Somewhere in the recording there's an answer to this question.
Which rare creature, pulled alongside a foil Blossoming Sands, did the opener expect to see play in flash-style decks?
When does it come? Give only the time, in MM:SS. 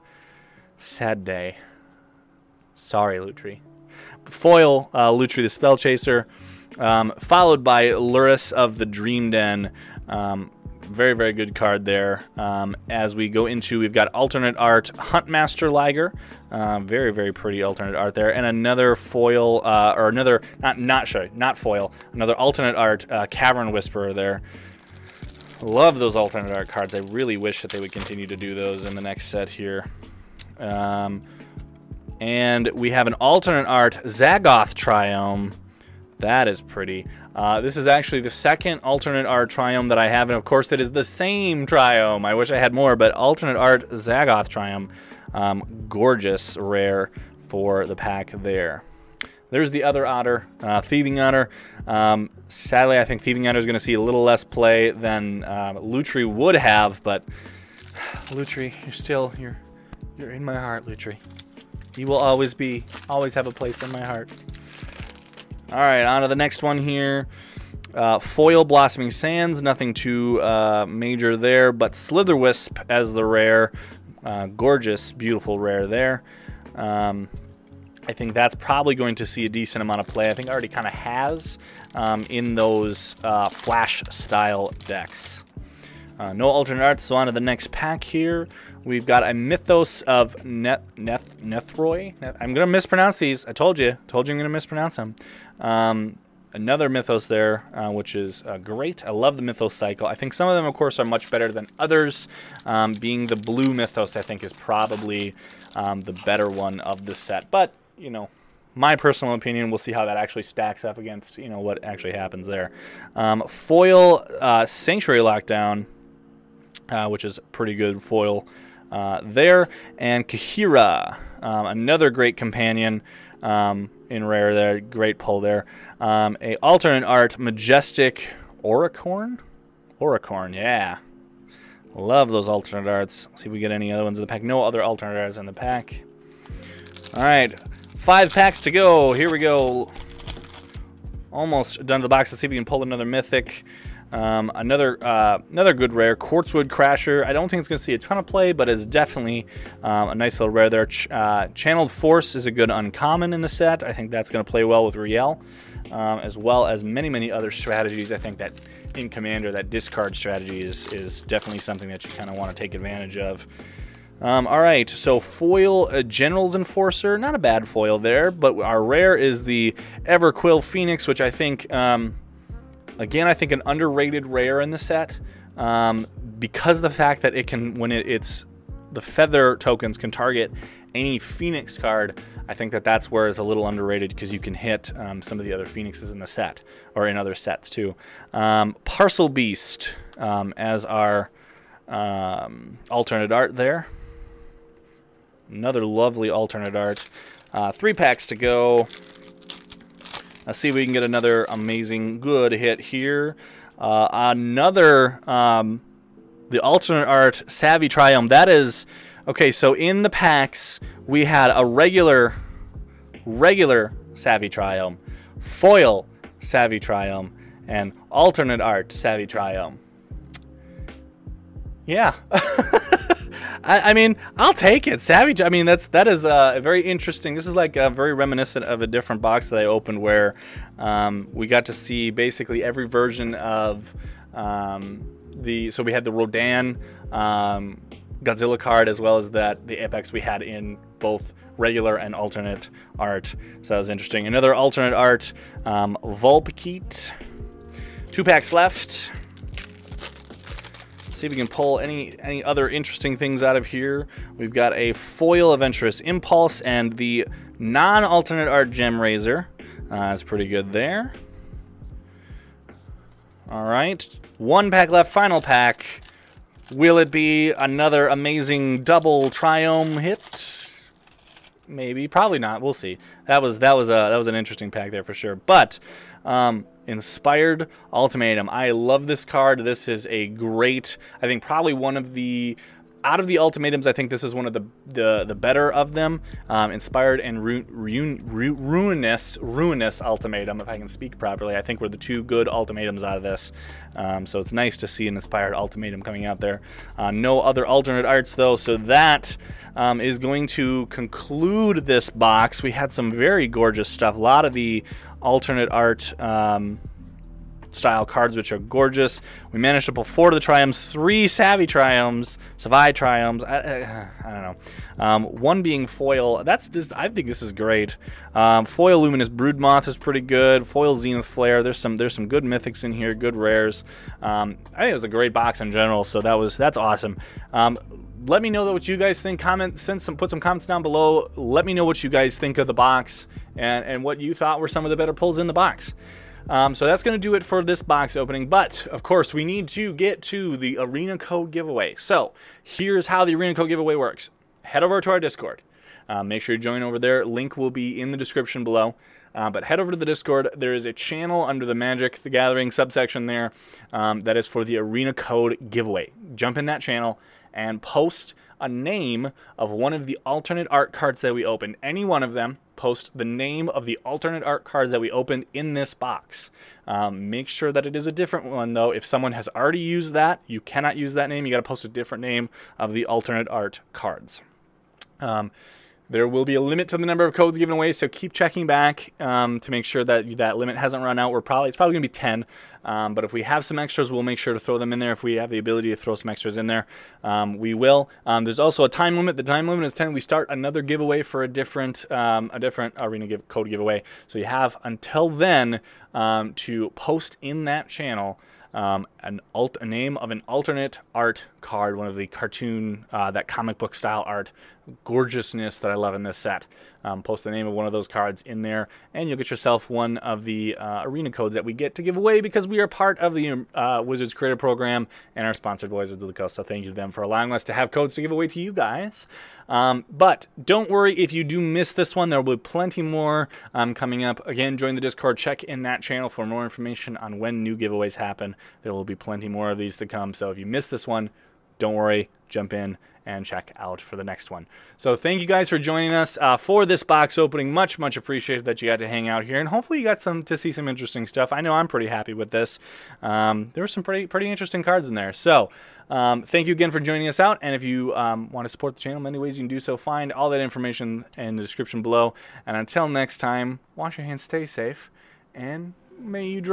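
01:11.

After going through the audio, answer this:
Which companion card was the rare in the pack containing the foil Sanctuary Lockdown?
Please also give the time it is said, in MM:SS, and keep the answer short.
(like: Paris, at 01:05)
Kaheera, at 02:00.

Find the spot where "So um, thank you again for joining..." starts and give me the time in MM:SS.
07:25.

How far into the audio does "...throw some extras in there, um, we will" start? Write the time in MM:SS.
06:25.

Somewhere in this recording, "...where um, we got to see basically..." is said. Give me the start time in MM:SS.
03:50.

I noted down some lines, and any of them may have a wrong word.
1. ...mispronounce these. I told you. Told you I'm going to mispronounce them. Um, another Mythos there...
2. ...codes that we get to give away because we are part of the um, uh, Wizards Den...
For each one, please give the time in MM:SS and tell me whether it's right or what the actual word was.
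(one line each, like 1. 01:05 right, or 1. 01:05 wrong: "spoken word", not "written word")
1. 01:32 right
2. 06:51 wrong: "Creator", not "Den".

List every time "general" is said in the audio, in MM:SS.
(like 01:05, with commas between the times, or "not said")
02:46, 05:25.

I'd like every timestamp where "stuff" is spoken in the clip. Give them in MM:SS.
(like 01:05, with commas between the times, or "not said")
05:03, 07:21.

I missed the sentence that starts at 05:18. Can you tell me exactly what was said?
Um, foil Luminous Broodmoth is pretty good.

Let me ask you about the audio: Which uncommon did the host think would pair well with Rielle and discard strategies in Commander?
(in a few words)
Channeled Force.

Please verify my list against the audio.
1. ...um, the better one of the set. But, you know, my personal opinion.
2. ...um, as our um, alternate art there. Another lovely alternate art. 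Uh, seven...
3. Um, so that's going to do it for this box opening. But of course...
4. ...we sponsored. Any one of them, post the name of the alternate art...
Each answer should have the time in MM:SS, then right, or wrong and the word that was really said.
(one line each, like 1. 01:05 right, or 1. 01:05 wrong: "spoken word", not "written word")
1. 01:45 right
2. 03:10 wrong: "three", not "seven"
3. 05:36 right
4. 06:01 wrong: "opened", not "sponsored".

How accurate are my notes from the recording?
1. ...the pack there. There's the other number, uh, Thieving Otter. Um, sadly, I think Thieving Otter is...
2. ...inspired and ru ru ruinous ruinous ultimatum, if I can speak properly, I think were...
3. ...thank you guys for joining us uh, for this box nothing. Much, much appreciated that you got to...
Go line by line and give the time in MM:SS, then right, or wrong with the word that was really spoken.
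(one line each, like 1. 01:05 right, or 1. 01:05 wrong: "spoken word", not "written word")
1. 00:47 wrong: "otter", not "number"
2. 04:46 right
3. 07:15 wrong: "opening", not "nothing".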